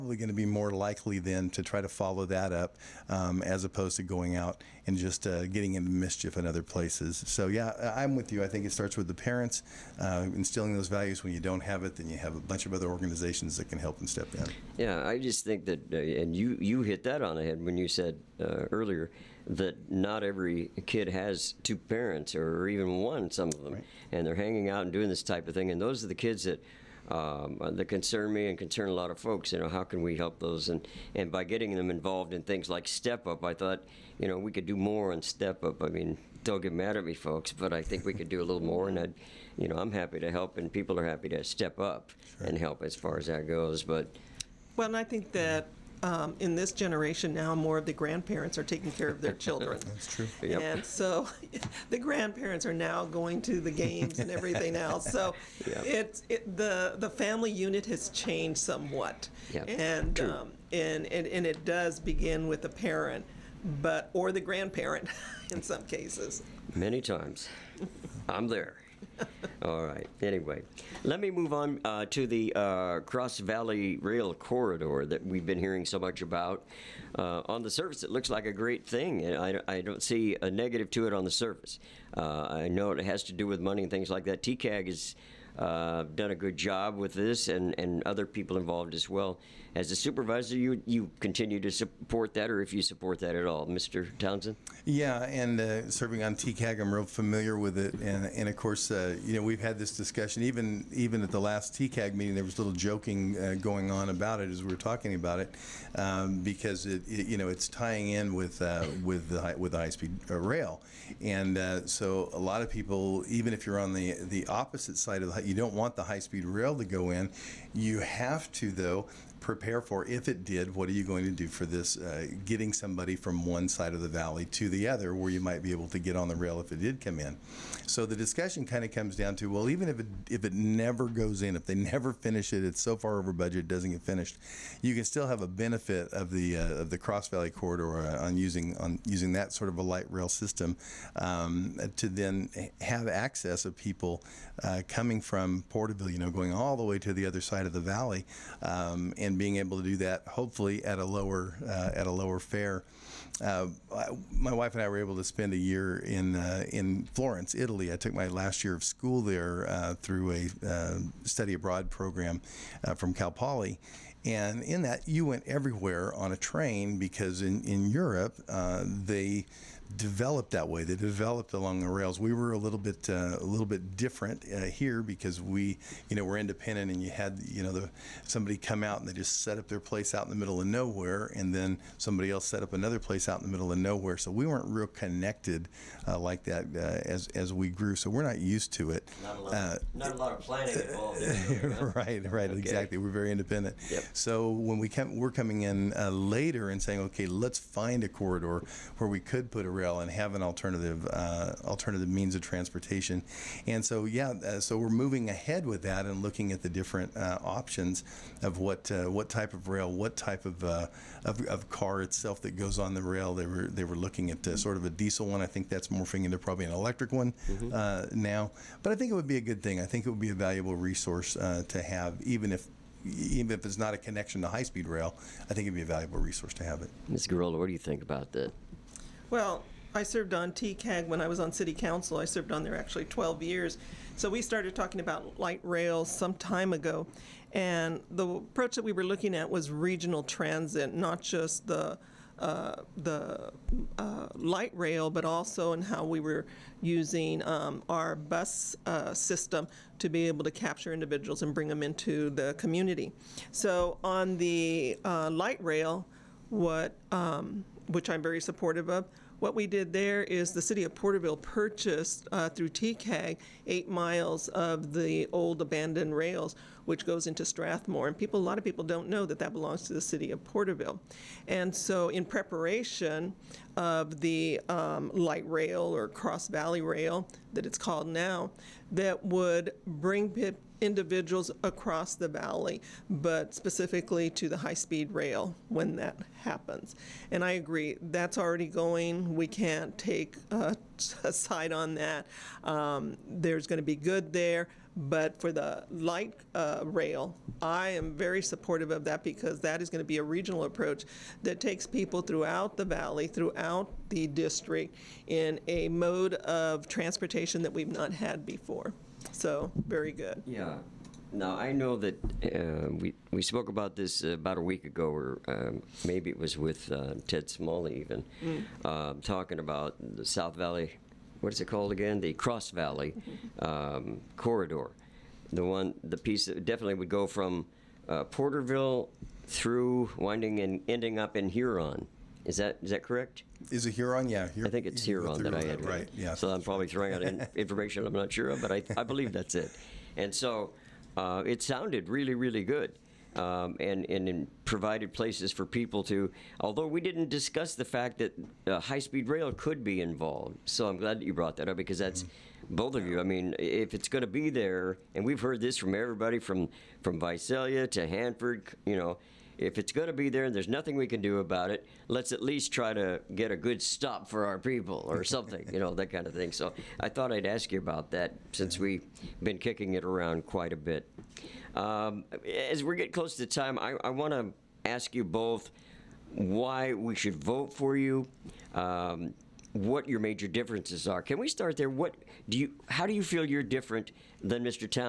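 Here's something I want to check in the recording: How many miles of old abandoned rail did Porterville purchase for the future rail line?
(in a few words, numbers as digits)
8.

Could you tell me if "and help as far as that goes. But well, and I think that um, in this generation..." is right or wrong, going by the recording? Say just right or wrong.
right.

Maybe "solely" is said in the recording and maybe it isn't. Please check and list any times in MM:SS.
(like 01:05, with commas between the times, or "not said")
not said.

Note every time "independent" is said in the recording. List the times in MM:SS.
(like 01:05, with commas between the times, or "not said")
02:56, 03:13.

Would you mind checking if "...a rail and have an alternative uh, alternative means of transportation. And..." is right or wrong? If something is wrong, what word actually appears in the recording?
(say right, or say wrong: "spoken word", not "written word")
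right.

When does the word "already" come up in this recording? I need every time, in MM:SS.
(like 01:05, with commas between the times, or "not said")
04:48.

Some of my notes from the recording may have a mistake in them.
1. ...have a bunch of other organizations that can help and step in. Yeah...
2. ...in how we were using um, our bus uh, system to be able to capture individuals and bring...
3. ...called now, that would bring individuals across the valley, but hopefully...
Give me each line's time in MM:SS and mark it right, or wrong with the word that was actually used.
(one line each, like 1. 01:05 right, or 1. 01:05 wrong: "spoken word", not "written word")
1. 00:12 right
2. 04:05 right
3. 04:37 wrong: "specifically", not "hopefully".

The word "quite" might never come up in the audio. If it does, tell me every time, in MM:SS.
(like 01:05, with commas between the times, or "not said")
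06:10.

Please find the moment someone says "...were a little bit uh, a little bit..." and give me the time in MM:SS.
02:52.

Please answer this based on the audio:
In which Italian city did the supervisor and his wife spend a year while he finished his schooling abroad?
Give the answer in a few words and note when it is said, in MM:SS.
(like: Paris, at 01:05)
Florence, at 02:37.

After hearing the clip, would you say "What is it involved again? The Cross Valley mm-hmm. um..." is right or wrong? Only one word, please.
wrong.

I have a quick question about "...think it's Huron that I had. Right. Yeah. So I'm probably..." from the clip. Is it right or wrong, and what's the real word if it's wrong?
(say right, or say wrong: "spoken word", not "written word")
right.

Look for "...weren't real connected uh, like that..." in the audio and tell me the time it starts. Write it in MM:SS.
03:04.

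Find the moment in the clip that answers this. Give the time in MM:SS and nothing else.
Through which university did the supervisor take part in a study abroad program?
02:43.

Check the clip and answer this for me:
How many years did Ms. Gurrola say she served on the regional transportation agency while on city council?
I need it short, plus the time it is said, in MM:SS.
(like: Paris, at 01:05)
12, at 03:53.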